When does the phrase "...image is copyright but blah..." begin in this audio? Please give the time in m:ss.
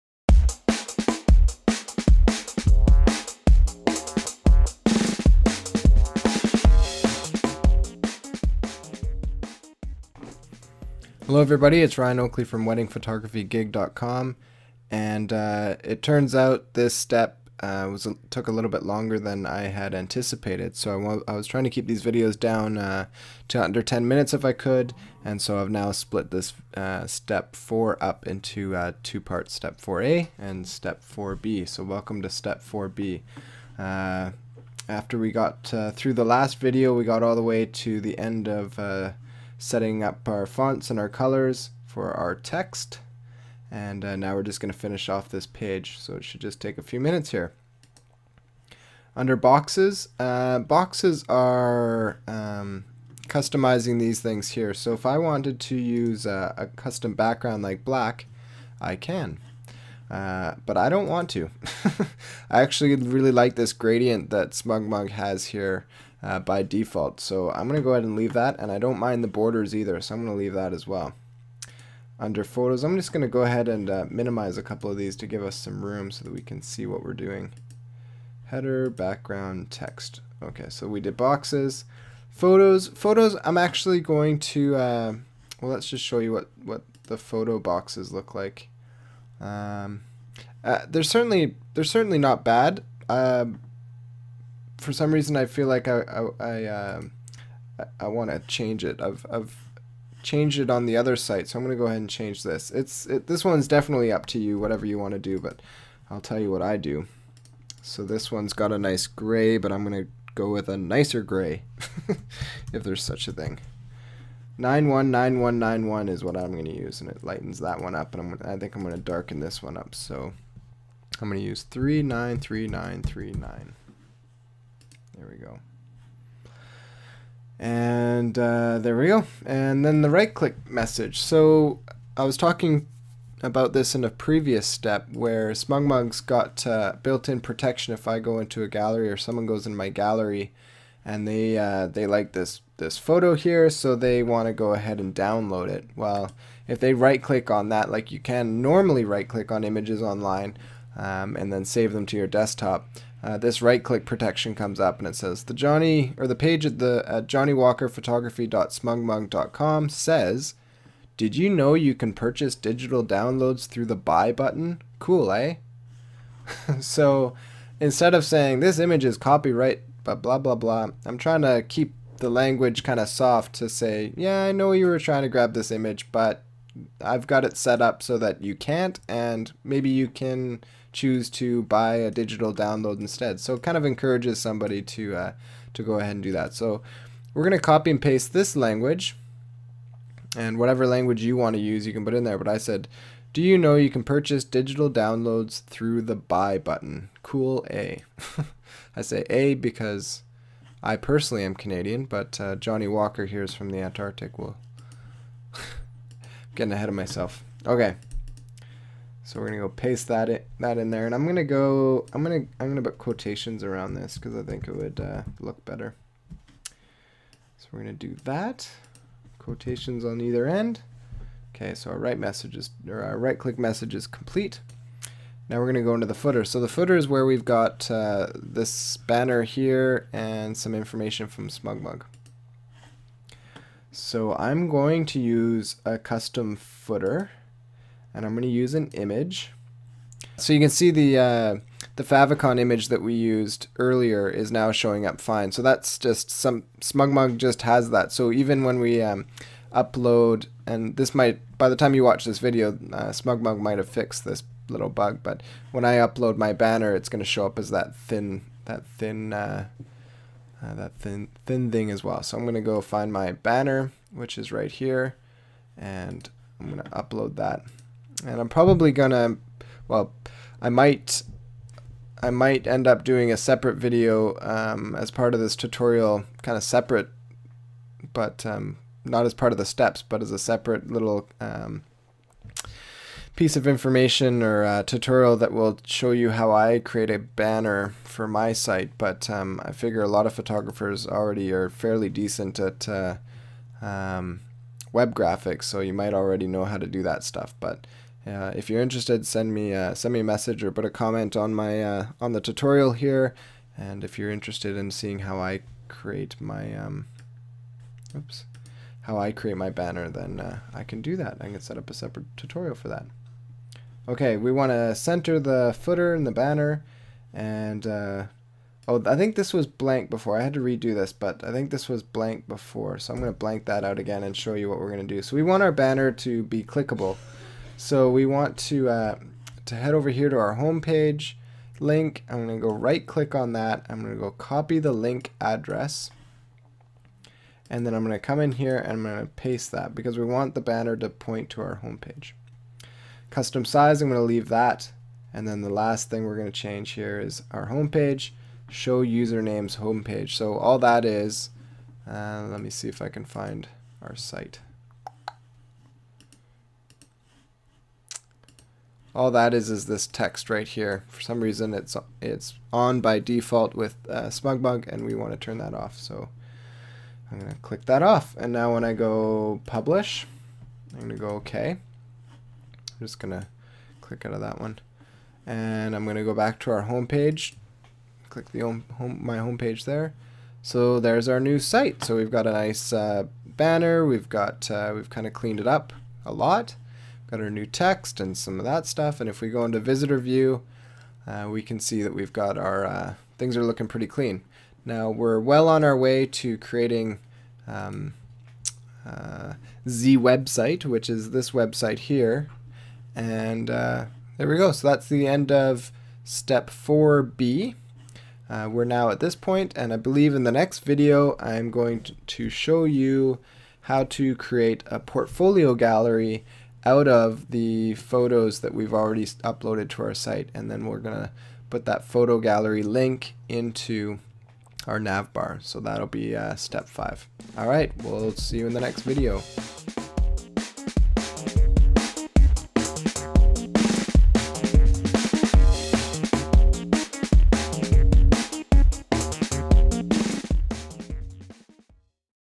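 2:48.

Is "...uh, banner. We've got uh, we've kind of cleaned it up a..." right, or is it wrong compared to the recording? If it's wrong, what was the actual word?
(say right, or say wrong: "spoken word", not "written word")
right.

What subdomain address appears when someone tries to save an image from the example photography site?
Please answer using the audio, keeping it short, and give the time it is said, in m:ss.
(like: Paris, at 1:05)
johnnywalkerphotography.smugmug.com, at 2:37.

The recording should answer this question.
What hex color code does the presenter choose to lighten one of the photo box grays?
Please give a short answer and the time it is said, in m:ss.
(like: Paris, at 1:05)
919191, at 1:54.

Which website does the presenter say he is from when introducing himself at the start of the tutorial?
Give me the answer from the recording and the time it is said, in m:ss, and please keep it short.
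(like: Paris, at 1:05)
weddingphotographygig.com, at 0:12.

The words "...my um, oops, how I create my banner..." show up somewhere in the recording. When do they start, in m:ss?
5:06.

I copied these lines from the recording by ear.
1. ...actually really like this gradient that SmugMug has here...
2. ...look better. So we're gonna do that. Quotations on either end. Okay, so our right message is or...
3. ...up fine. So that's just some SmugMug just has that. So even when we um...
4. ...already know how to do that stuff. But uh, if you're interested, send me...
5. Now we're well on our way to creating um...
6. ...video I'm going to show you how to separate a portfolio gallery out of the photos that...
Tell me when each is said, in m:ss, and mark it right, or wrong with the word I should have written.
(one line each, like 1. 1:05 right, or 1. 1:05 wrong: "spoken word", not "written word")
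1. 1:02 right
2. 3:35 right
3. 4:05 right
4. 4:56 right
5. 6:34 right
6. 6:50 wrong: "create", not "separate".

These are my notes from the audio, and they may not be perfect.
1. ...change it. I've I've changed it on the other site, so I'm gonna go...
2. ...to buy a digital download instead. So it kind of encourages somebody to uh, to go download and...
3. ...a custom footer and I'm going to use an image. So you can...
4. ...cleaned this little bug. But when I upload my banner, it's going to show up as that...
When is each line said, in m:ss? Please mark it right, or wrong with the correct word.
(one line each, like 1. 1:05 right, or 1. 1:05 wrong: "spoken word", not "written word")
1. 1:38 right
2. 3:01 wrong: "ahead", not "download"
3. 3:55 right
4. 4:13 wrong: "fixed", not "cleaned".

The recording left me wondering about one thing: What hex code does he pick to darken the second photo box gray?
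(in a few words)
393939.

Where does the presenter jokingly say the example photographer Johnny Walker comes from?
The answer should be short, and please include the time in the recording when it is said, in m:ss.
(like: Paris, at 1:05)
the Antarctic, at 3:23.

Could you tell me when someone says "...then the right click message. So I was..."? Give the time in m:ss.
2:09.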